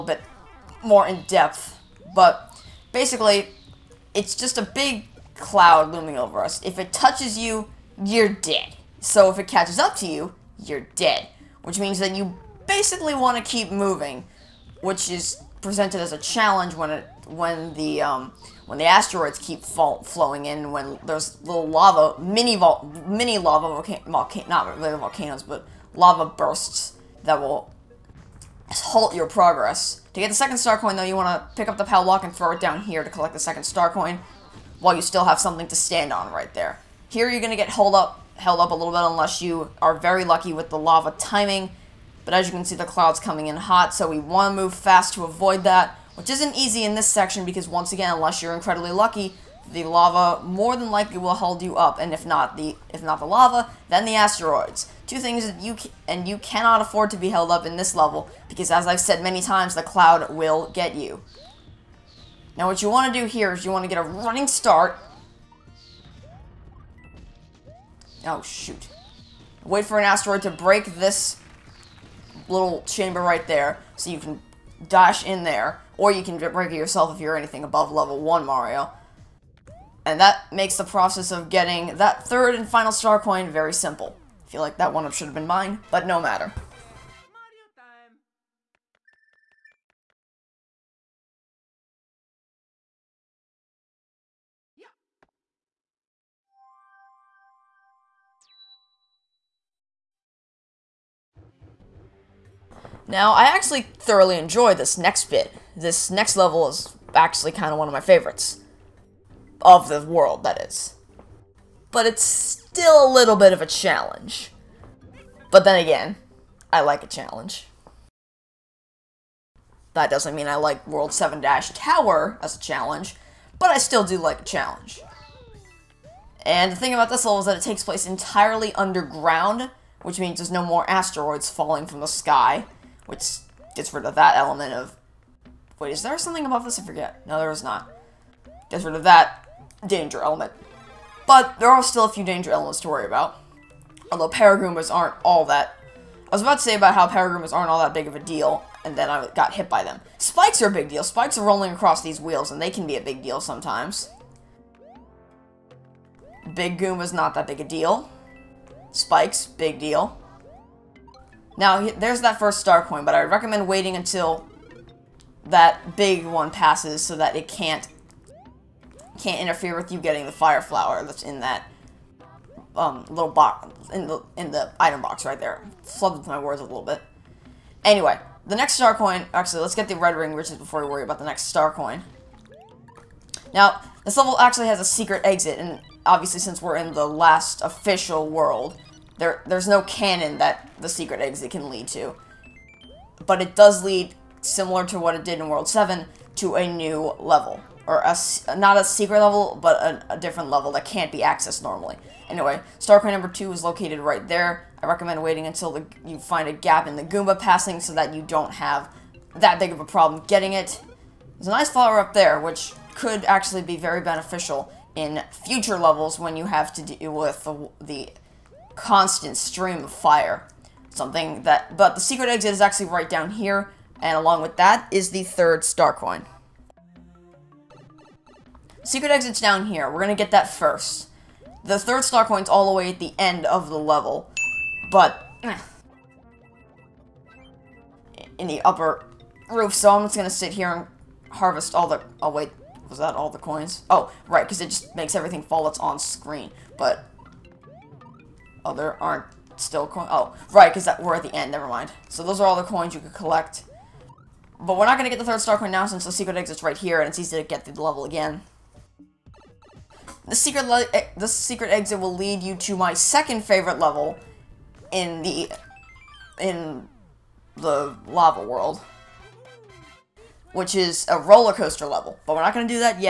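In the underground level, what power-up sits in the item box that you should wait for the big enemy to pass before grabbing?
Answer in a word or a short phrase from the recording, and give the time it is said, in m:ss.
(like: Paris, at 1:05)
Fire flower, at 2:50.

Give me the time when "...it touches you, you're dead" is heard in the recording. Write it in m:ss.
0:06.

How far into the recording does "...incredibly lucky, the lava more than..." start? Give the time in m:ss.
0:48.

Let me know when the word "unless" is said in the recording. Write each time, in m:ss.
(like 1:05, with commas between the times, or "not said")
0:39, 0:48.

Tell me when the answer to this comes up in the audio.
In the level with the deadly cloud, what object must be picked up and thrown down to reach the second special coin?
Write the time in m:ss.
0:31.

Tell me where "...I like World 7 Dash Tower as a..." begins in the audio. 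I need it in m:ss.
2:00.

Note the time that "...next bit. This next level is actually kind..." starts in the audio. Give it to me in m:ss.
1:44.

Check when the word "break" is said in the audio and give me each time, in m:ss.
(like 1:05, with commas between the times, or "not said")
1:10, 1:16.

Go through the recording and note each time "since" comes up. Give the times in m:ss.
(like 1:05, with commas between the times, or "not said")
3:06, 4:15.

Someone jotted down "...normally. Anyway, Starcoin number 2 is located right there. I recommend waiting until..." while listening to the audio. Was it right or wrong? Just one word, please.
right.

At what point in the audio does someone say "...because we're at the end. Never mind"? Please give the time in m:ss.
4:10.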